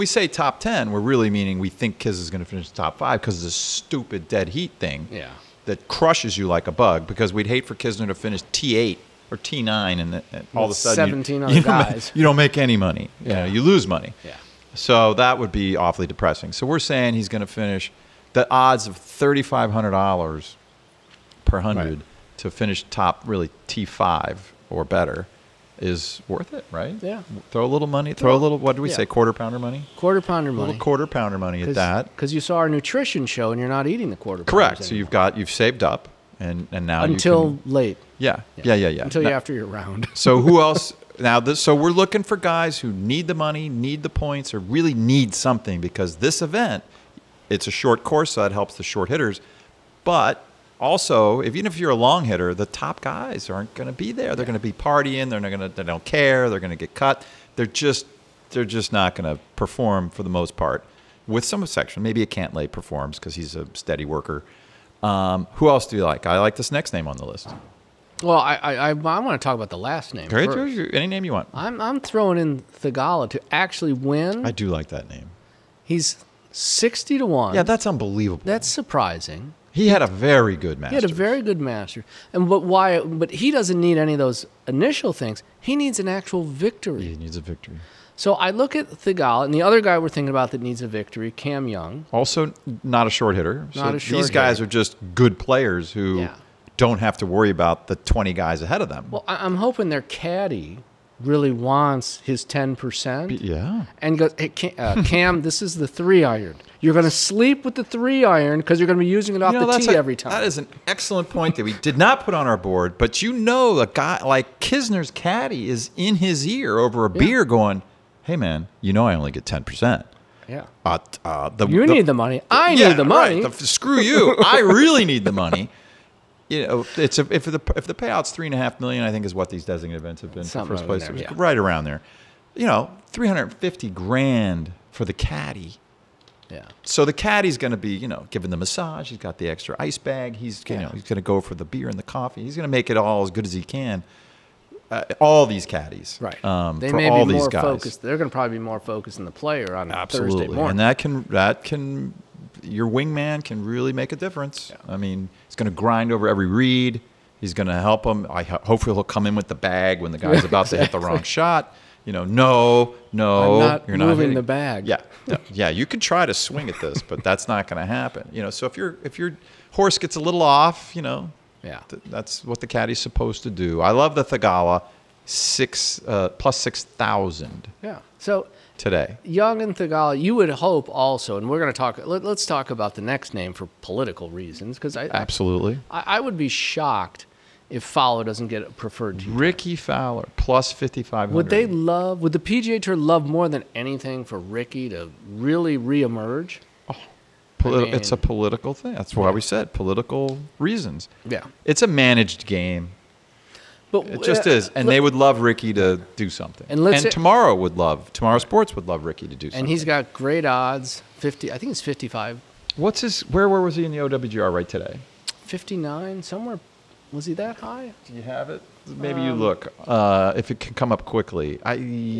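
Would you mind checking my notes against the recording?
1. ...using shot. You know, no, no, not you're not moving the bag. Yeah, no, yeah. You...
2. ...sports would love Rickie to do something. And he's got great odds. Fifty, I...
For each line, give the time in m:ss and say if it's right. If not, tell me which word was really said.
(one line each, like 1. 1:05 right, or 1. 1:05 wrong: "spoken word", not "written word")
1. 2:40 wrong: "wrong", not "using"
2. 3:28 right.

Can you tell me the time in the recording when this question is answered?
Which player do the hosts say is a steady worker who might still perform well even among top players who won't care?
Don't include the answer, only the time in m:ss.
1:02.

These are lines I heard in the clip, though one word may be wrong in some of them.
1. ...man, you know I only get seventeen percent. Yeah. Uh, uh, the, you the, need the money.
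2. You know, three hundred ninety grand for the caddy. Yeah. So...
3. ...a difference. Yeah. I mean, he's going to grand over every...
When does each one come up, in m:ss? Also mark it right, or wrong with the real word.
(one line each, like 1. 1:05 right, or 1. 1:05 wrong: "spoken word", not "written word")
1. 1:58 wrong: "ten", not "seventeen"
2. 2:12 wrong: "fifty", not "ninety"
3. 2:34 wrong: "grind", not "grand".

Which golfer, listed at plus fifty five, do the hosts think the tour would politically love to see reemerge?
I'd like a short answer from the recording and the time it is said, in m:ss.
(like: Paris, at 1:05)
Rickie Fowler, at 3:09.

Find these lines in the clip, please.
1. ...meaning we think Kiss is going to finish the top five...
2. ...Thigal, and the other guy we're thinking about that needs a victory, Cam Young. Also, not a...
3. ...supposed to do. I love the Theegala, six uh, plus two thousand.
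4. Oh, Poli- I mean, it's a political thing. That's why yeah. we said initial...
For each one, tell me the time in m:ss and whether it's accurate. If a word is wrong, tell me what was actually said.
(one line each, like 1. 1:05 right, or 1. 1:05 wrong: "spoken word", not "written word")
1. 0:01 right
2. 1:28 right
3. 2:52 wrong: "six", not "two"
4. 3:16 wrong: "political", not "initial".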